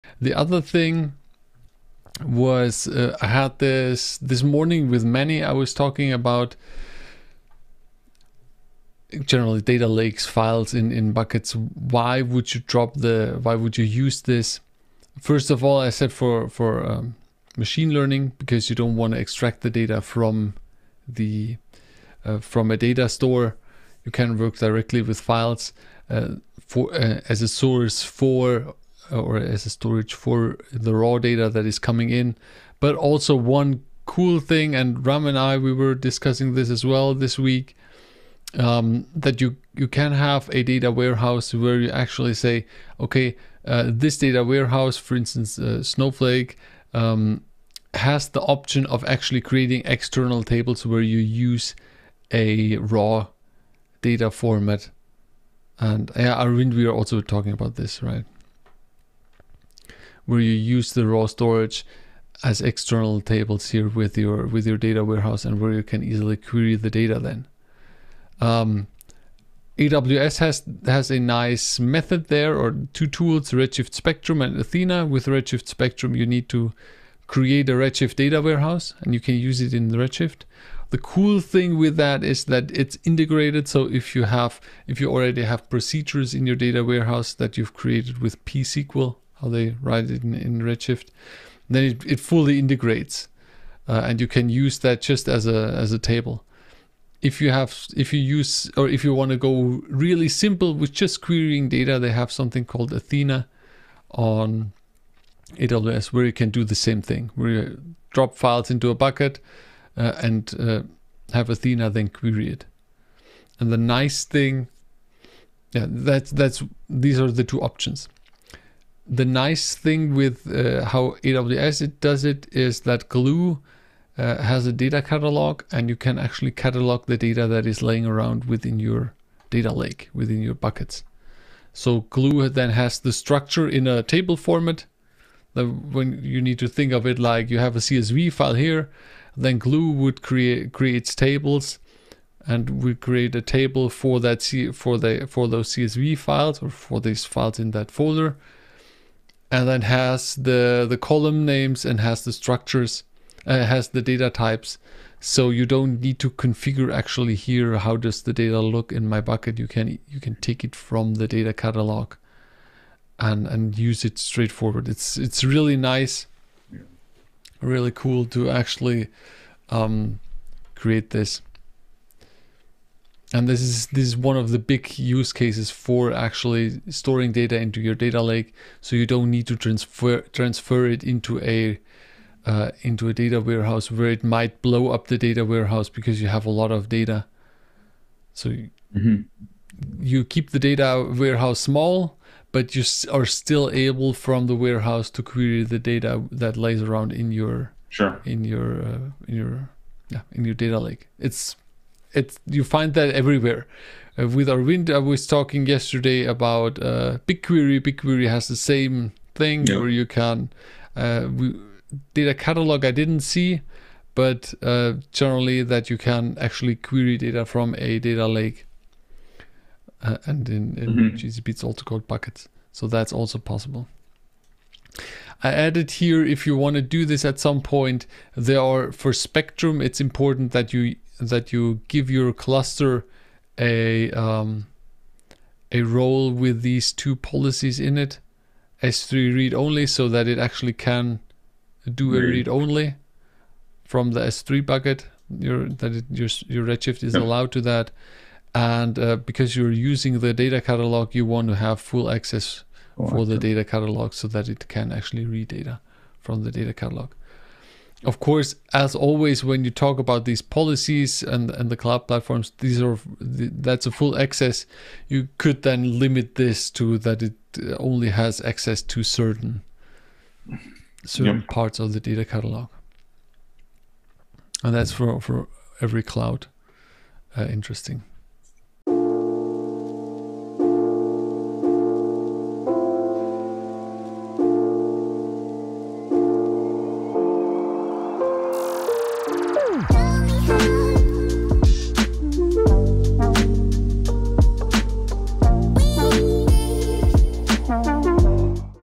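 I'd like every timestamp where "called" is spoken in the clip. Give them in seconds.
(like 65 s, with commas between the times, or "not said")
102 s, 221 s.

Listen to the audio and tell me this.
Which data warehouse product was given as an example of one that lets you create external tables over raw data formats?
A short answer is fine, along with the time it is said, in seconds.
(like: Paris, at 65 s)
Snowflake, at 45 s.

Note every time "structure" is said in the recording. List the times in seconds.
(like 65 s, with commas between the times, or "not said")
133 s, 152 s.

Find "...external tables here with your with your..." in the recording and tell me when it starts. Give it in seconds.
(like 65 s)
62 s.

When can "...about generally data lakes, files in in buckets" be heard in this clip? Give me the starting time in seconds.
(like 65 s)
6 s.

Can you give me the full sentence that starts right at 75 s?
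With Redshift Spectrum, you need to create a Redshift data warehouse and you can use it in Redshift.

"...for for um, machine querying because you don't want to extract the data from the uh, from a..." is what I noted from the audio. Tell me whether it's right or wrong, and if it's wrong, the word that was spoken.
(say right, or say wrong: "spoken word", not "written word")
wrong: "learning", not "querying".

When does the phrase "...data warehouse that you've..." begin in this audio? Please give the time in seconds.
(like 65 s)
86 s.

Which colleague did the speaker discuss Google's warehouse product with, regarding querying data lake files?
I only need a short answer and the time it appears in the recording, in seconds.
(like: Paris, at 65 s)
Arvind, at 204 s.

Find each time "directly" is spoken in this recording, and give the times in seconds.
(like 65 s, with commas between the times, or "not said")
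24 s.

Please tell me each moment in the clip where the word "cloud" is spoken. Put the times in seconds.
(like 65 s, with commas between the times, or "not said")
261 s, 276 s.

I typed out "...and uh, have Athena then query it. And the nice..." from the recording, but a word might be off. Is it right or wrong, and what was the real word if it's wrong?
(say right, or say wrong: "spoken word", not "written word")
right.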